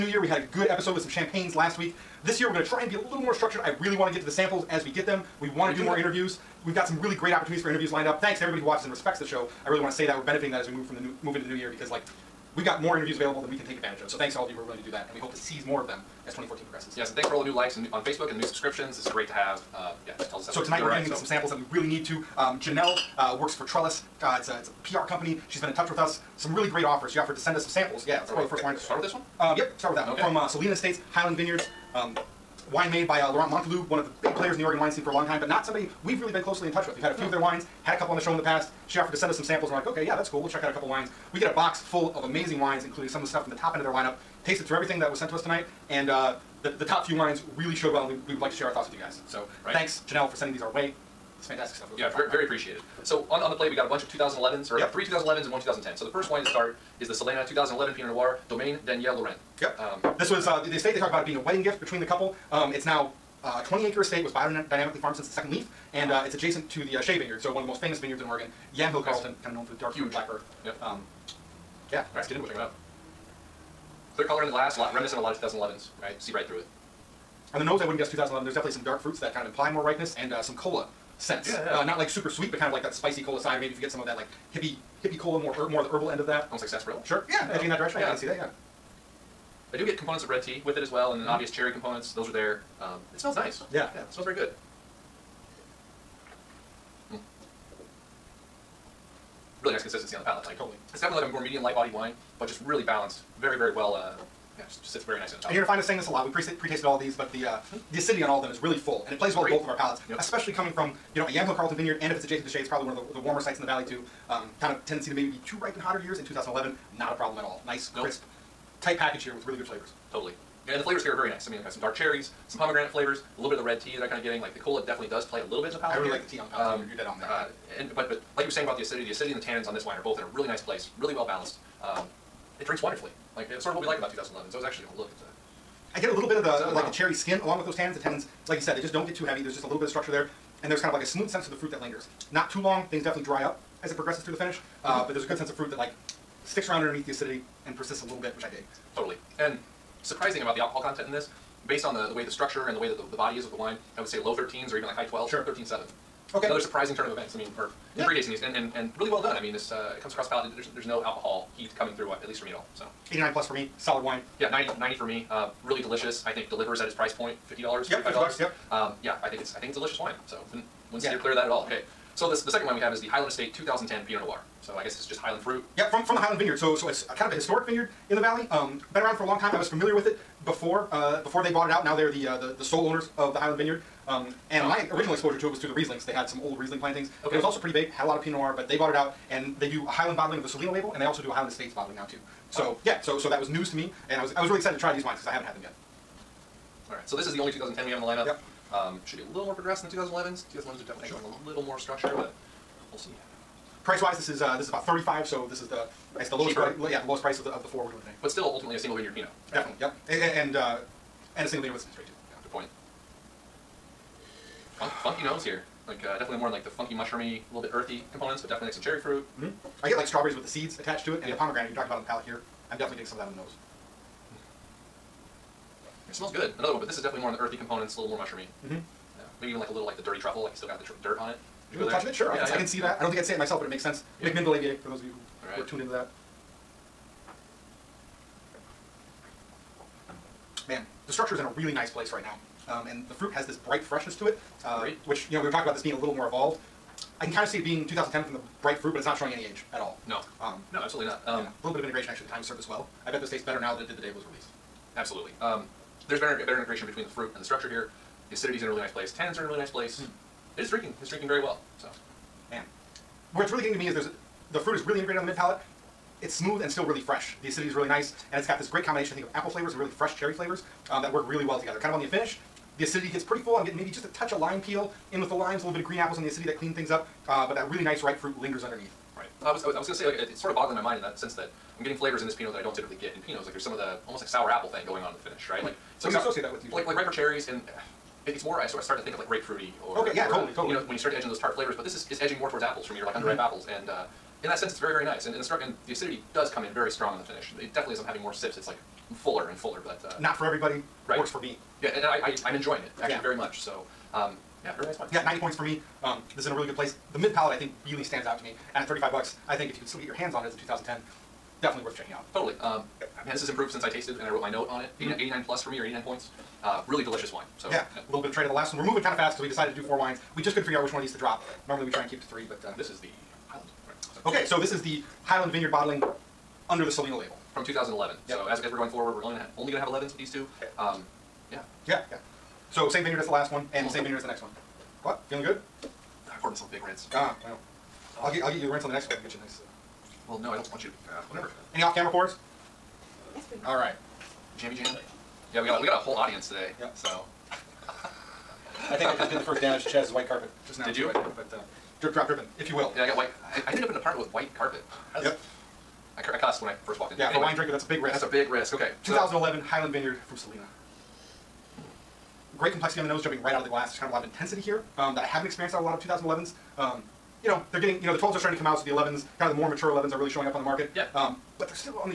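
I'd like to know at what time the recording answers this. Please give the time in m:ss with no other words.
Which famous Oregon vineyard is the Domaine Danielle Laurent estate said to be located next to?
1:07.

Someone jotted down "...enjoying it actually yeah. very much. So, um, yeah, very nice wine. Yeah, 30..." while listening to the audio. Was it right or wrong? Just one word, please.
wrong.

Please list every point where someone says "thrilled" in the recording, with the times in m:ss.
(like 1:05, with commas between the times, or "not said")
not said.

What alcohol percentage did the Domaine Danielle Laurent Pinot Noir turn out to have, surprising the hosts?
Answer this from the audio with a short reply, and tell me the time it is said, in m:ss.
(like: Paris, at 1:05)
13.7, at 2:35.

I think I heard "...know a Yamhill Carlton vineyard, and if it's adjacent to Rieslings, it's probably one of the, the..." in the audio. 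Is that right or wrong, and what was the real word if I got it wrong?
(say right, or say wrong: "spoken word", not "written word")
wrong: "Shea", not "Rieslings".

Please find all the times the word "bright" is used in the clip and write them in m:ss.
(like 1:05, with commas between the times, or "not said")
4:03, 4:08.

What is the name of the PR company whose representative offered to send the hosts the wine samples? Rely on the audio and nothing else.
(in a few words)
Trellis.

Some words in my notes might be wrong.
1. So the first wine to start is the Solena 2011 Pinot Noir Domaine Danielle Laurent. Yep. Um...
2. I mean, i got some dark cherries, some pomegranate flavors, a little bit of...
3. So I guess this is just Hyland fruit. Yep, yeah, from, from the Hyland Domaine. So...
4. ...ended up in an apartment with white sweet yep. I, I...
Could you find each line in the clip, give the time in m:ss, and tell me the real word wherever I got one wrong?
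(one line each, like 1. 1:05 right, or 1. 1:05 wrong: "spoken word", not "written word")
1. 0:55 right
2. 2:01 right
3. 2:54 wrong: "Vineyard", not "Domaine"
4. 5:53 wrong: "carpet", not "sweet".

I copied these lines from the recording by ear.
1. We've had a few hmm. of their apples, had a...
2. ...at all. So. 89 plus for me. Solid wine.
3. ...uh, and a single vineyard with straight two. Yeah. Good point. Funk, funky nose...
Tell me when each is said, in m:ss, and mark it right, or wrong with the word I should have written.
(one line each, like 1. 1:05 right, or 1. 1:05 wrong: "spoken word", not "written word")
1. 0:36 wrong: "wines", not "apples"
2. 2:42 right
3. 3:30 right.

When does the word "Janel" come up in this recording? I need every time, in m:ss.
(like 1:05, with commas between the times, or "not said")
0:22, 0:50.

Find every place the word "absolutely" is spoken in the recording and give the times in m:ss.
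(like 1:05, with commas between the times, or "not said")
4:10, 4:14.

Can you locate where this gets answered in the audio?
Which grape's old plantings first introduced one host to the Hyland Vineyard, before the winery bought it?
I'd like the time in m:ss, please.
3:05.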